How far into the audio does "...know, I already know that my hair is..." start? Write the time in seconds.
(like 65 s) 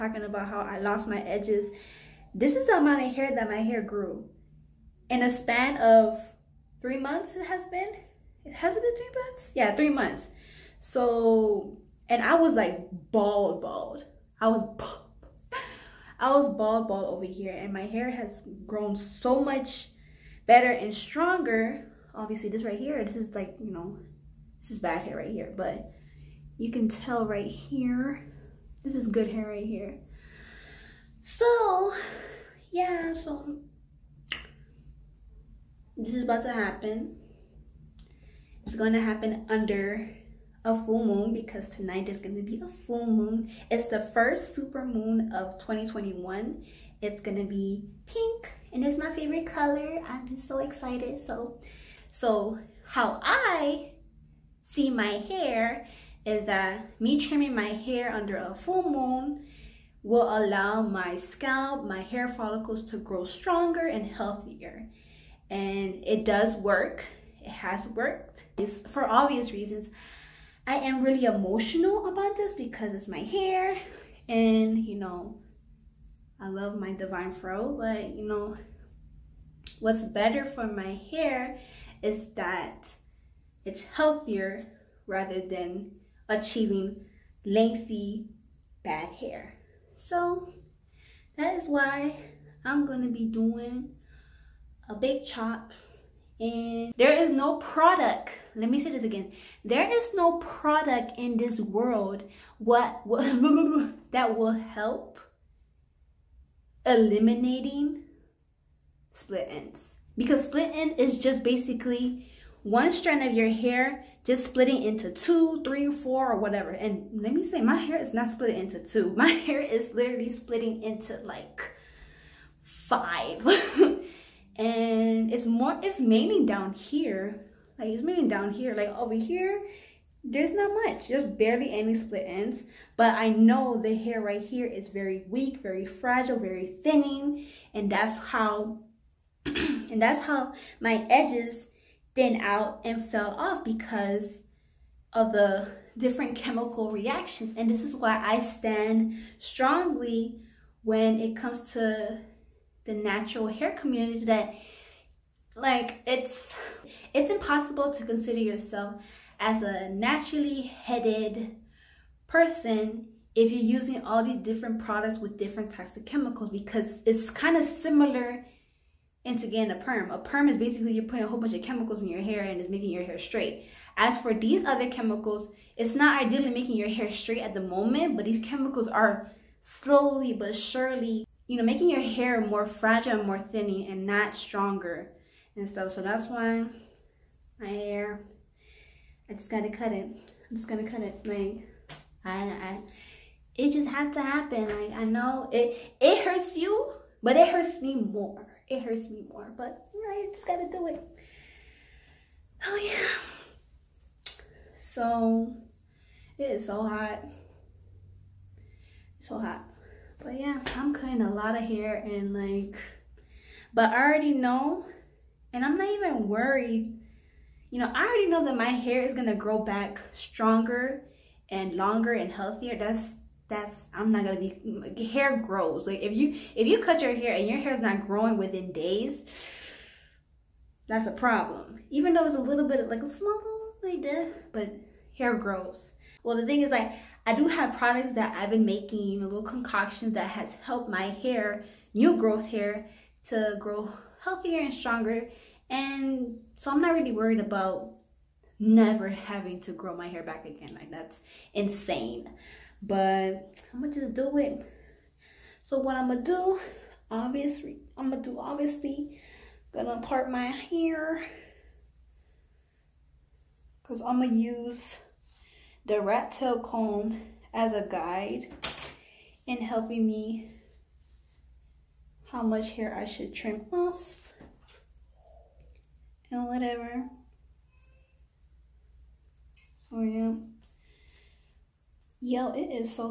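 217 s.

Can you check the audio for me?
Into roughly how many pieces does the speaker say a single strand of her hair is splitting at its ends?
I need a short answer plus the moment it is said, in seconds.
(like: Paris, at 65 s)
5, at 122 s.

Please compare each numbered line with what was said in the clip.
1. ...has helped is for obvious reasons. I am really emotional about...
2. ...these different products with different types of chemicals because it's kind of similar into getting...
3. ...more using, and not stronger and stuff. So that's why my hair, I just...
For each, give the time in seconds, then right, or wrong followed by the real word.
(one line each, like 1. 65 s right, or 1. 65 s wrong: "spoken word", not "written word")
1. 67 s wrong: "worked", not "helped"
2. 164 s right
3. 183 s wrong: "thinning", not "using".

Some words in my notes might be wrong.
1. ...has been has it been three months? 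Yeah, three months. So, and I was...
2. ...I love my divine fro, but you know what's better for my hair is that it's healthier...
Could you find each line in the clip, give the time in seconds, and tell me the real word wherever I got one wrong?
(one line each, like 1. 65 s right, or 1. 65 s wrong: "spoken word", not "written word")
1. 7 s right
2. 76 s right.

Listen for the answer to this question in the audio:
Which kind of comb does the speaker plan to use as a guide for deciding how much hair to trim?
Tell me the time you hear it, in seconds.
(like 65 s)
265 s.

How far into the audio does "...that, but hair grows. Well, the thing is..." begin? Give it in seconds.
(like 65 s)
234 s.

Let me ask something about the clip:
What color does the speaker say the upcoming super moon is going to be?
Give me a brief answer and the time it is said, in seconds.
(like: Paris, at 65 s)
Pink, at 48 s.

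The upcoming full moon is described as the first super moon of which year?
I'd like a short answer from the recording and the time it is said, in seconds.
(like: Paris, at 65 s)
2021, at 45 s.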